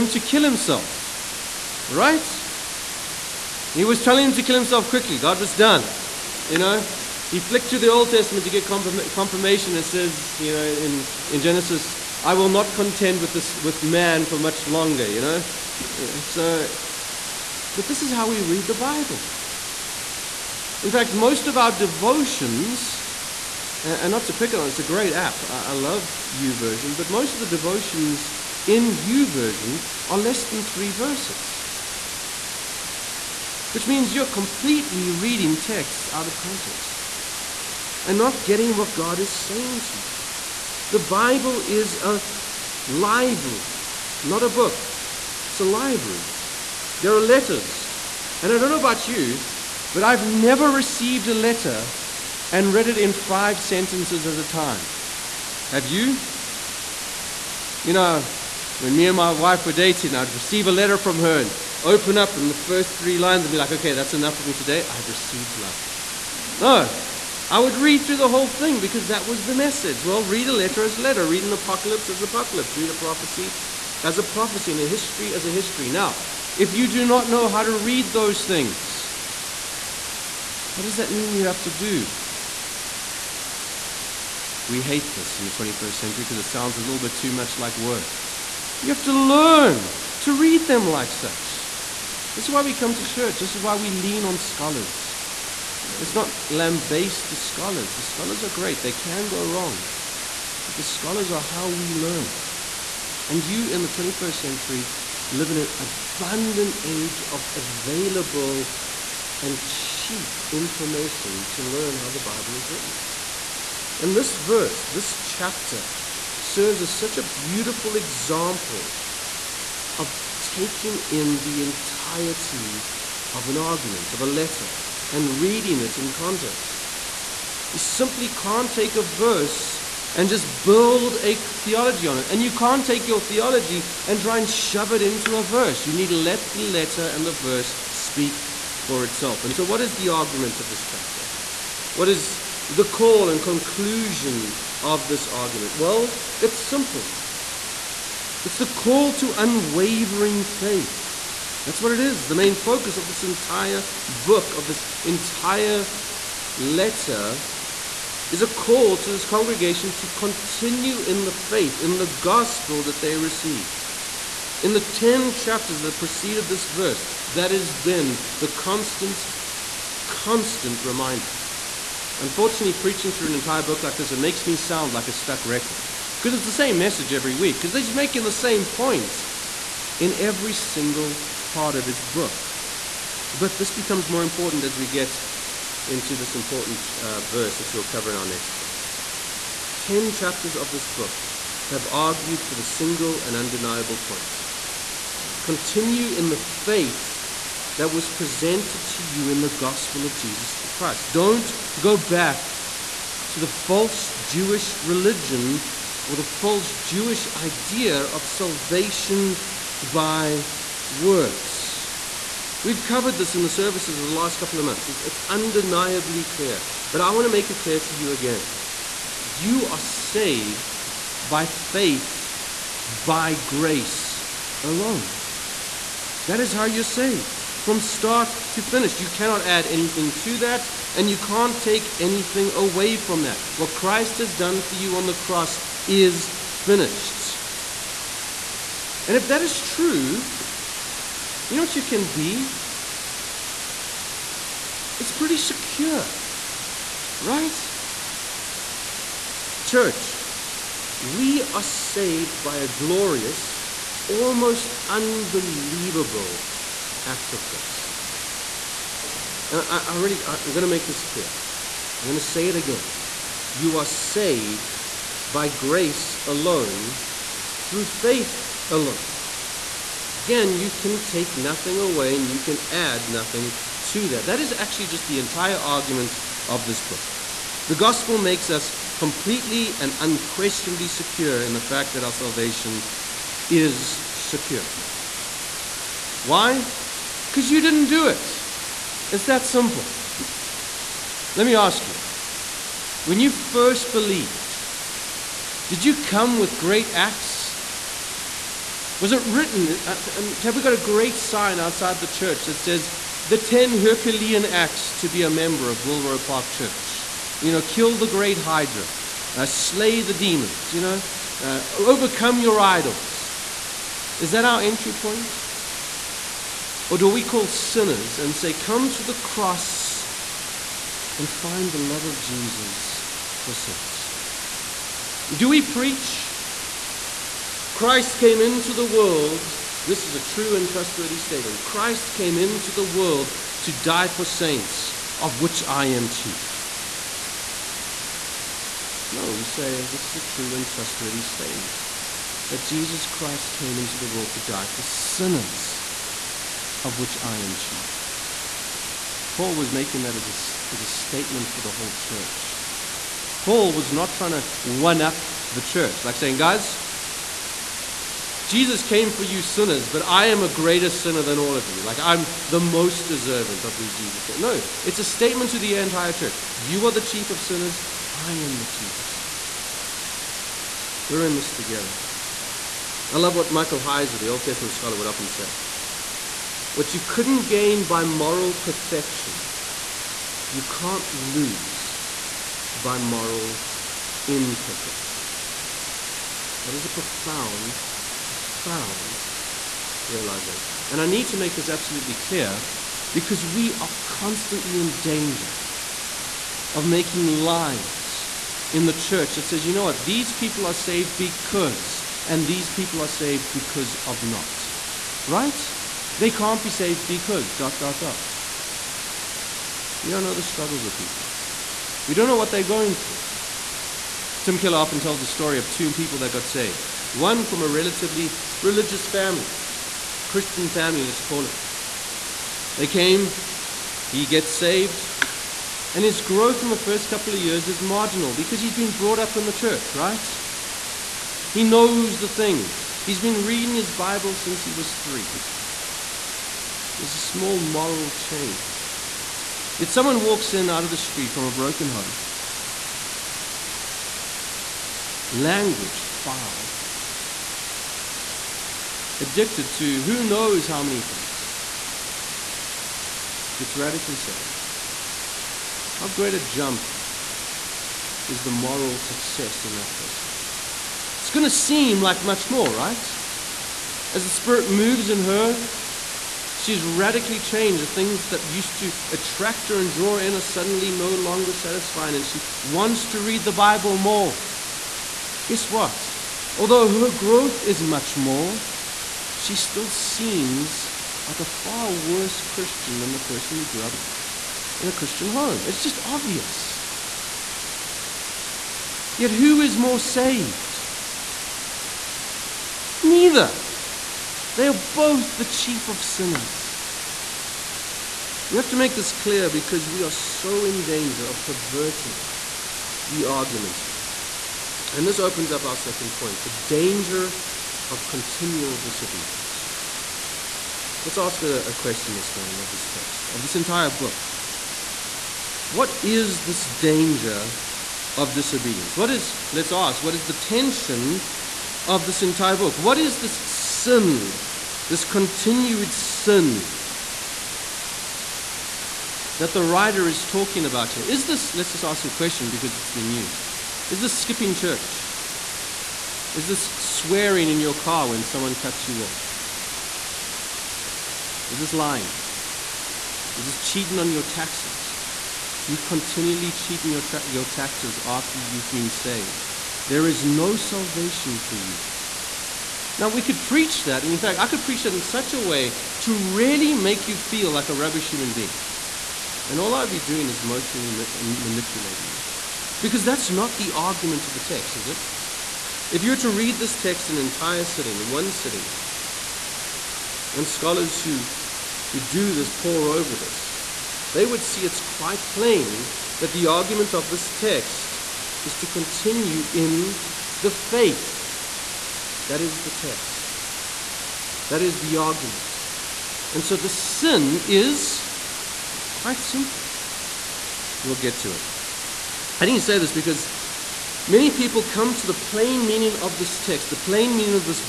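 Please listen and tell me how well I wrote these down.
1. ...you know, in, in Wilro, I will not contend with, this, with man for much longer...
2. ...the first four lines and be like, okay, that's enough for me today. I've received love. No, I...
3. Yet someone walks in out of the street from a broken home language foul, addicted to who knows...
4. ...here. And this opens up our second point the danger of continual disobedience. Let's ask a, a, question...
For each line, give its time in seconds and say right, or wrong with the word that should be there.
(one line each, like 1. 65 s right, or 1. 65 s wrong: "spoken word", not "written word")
1. 10 s wrong: "Genesis", not "Wilro"
2. 62 s wrong: "three", not "four"
3. 439 s right
4. 503 s right.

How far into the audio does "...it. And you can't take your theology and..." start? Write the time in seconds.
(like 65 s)
132 s.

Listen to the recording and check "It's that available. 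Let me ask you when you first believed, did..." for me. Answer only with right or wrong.
wrong.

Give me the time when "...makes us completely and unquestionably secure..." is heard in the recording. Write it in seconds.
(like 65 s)
278 s.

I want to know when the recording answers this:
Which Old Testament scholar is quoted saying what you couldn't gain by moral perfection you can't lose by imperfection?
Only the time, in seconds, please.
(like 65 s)
373 s.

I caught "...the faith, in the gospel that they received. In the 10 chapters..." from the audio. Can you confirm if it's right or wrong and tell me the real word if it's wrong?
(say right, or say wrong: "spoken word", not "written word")
right.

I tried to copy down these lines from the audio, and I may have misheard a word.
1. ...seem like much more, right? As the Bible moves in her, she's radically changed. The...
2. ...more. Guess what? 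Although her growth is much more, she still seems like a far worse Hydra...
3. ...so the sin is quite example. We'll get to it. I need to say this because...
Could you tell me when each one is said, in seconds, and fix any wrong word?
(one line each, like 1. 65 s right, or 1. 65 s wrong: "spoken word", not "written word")
1. 461 s wrong: "Spirit", not "Bible"
2. 473 s wrong: "Christian", not "Hydra"
3. 586 s wrong: "simple", not "example".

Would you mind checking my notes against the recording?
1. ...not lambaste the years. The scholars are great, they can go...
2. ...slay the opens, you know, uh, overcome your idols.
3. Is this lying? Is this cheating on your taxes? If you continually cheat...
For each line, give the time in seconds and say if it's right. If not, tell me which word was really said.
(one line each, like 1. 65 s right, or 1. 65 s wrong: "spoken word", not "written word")
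1. 96 s wrong: "scholars", not "years"
2. 309 s wrong: "demons", not "opens"
3. 541 s right.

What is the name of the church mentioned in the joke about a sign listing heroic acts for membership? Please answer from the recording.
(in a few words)
Wilro Park Church.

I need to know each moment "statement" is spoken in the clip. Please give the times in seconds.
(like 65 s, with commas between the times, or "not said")
331 s, 341 s, 350 s, 365 s.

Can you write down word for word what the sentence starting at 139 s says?
And so, what is the argument of this chapter?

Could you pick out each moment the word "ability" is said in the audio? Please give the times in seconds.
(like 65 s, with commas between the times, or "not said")
not said.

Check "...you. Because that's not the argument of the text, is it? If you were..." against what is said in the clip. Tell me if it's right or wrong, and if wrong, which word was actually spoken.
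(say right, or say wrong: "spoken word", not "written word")
right.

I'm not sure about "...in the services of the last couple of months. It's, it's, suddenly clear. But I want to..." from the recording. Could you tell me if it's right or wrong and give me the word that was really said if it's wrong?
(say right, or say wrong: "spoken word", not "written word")
wrong: "undeniably", not "suddenly".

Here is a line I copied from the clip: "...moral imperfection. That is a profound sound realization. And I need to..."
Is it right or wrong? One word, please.
wrong.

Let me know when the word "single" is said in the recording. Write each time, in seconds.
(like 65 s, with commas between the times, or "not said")
180 s, 192 s.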